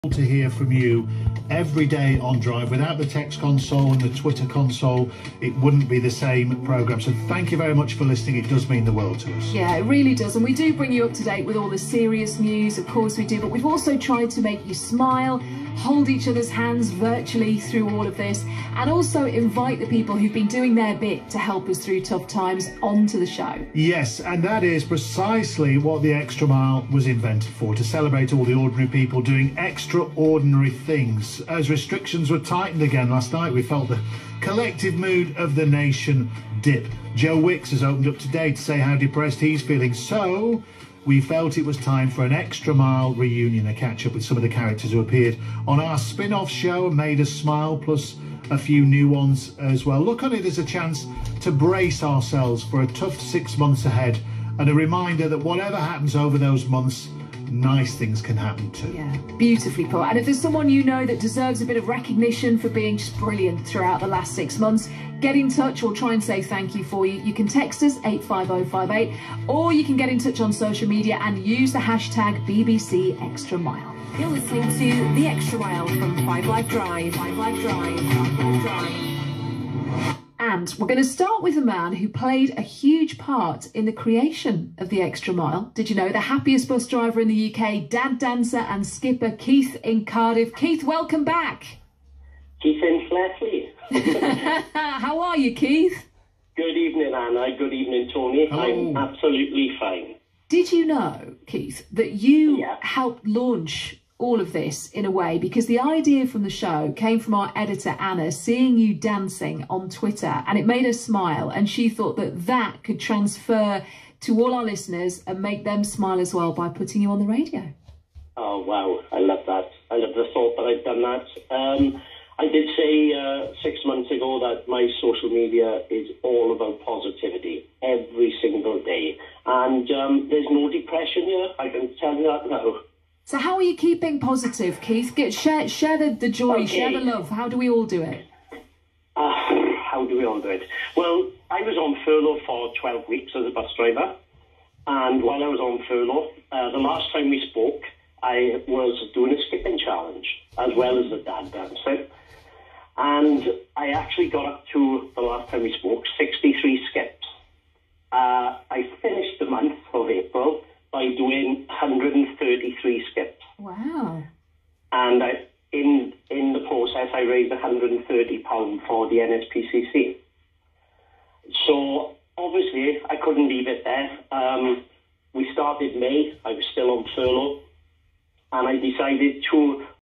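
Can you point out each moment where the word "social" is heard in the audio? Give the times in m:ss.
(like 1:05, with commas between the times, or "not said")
1:10, 2:05.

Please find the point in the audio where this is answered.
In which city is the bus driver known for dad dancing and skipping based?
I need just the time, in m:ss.
1:30.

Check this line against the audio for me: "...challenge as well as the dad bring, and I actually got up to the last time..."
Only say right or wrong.
wrong.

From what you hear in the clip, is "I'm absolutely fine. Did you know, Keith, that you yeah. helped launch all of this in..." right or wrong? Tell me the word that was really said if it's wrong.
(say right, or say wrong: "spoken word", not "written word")
right.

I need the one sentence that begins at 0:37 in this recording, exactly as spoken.
Joe Wicks has opened up today to say how depressed he's feeling.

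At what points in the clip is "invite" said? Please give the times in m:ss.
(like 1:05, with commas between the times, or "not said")
0:19.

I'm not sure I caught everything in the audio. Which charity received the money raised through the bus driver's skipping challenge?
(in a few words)
NSPCC.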